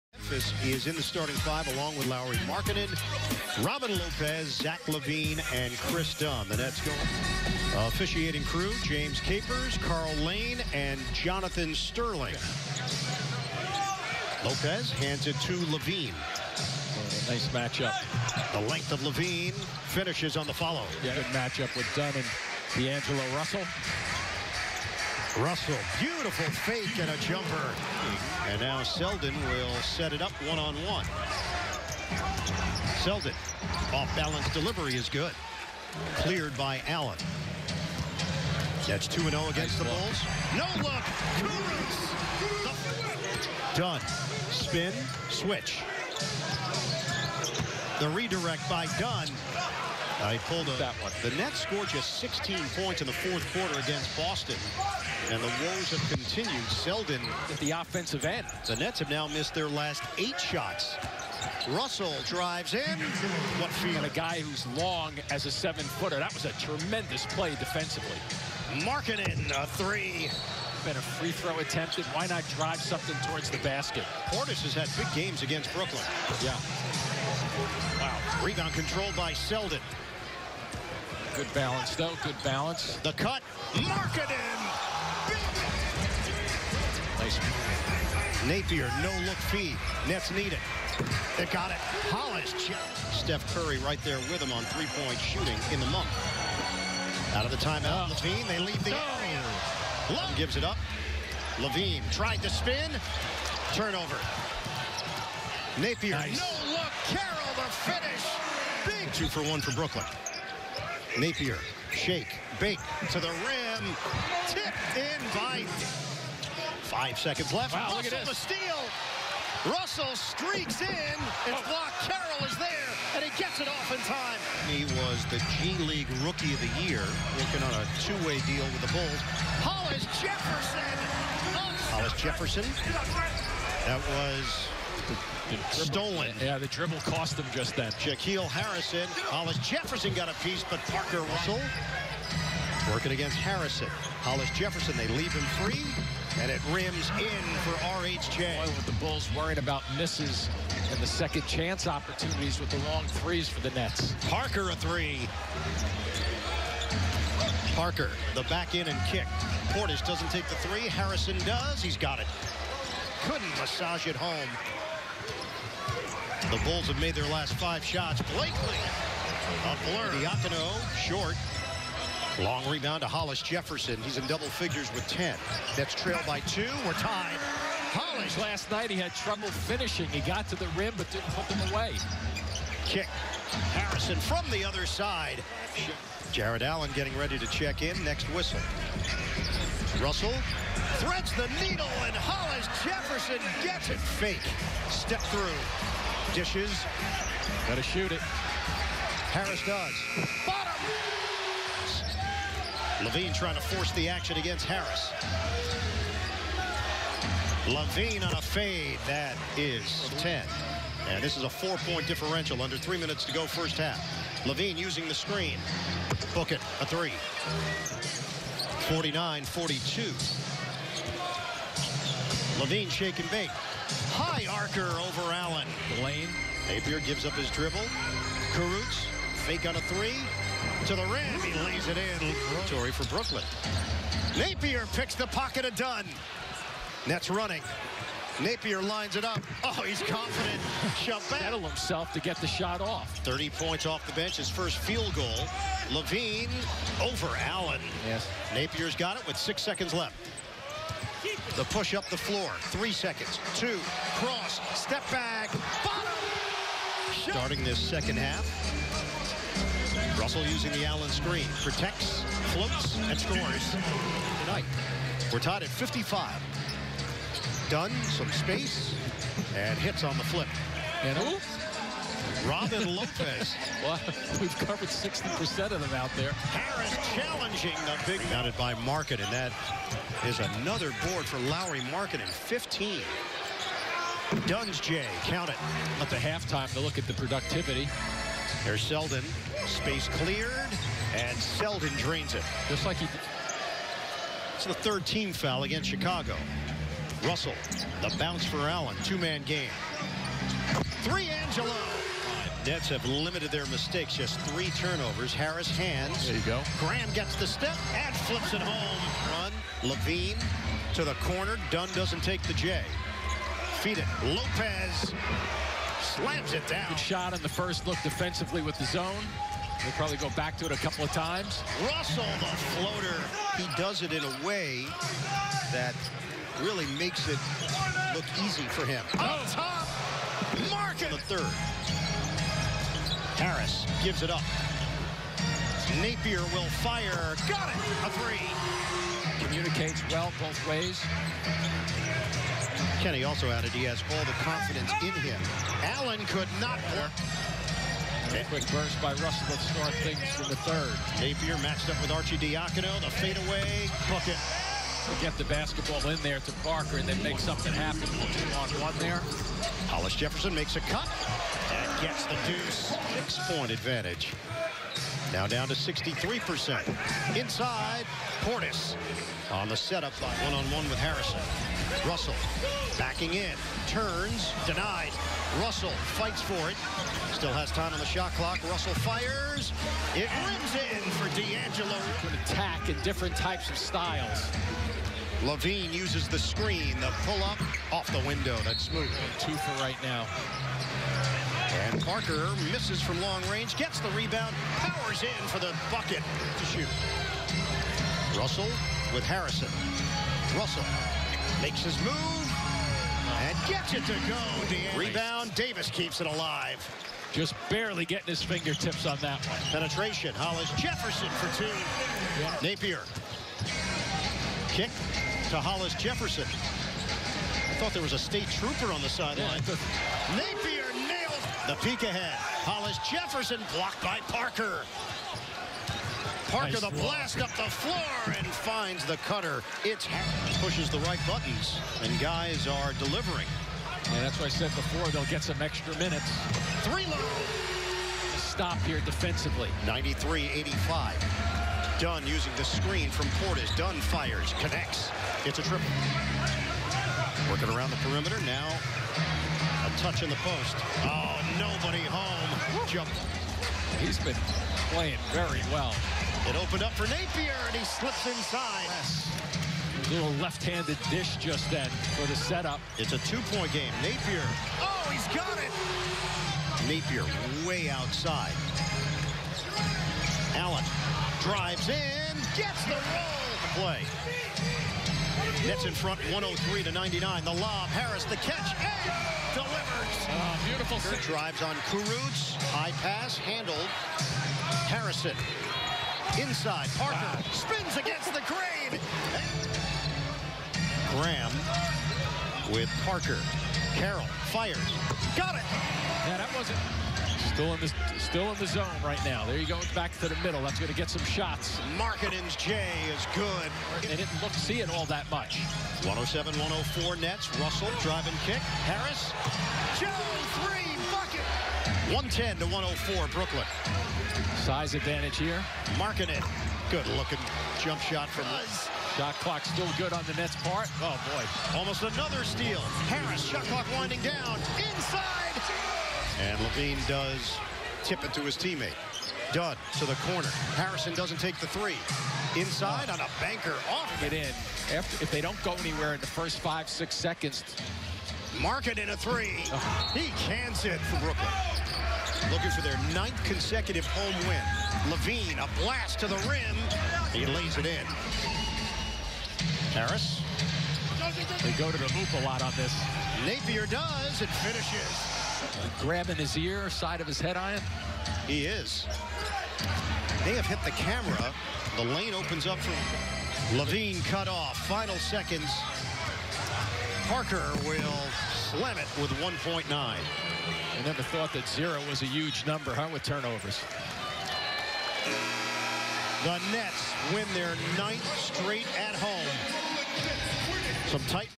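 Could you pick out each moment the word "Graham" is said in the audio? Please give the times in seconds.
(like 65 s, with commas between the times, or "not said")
306 s, 491 s.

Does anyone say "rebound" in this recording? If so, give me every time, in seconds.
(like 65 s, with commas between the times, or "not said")
78 s, 172 s, 394 s, 405 s.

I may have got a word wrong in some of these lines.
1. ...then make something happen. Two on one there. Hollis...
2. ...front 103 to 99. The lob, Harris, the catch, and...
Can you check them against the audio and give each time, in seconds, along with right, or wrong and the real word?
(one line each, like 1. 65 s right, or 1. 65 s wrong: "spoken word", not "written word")
1. 357 s right
2. 475 s right.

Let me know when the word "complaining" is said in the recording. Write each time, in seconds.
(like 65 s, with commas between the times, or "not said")
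not said.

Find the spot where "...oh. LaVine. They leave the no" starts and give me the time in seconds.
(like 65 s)
98 s.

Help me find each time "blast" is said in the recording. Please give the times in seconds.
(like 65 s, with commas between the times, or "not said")
426 s, 545 s.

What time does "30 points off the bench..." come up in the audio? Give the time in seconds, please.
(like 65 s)
243 s.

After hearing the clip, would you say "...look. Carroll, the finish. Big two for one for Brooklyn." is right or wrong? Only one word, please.
right.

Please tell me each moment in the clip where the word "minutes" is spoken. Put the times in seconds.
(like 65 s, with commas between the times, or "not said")
212 s, 435 s.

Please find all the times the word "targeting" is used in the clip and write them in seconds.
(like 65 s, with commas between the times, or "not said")
not said.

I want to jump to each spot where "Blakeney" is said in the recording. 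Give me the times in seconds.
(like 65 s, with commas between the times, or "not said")
168 s.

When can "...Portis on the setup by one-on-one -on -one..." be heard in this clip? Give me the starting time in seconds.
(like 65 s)
368 s.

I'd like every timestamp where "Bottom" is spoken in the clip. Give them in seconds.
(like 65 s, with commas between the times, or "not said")
200 s, 255 s.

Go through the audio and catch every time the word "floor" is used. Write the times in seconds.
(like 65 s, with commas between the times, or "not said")
252 s, 427 s.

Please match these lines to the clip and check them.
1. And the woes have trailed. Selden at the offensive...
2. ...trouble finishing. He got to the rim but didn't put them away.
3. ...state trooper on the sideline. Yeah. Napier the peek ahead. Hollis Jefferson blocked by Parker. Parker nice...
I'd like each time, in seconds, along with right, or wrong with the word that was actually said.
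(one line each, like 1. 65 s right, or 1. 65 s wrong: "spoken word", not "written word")
1. 55 s wrong: "continued", not "trailed"
2. 179 s right
3. 418 s right.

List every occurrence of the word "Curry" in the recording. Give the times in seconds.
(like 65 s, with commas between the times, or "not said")
93 s.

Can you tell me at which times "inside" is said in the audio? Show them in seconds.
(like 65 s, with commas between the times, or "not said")
367 s, 458 s, 486 s, 524 s, 532 s.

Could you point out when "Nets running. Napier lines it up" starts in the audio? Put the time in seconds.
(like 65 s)
237 s.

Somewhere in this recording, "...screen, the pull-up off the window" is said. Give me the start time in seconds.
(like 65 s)
386 s.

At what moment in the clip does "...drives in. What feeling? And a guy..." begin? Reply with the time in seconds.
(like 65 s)
62 s.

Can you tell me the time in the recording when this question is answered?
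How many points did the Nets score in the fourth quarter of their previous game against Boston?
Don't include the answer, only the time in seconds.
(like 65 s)
52 s.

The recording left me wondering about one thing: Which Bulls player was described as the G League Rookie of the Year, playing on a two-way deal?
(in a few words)
Shaquille Harrison.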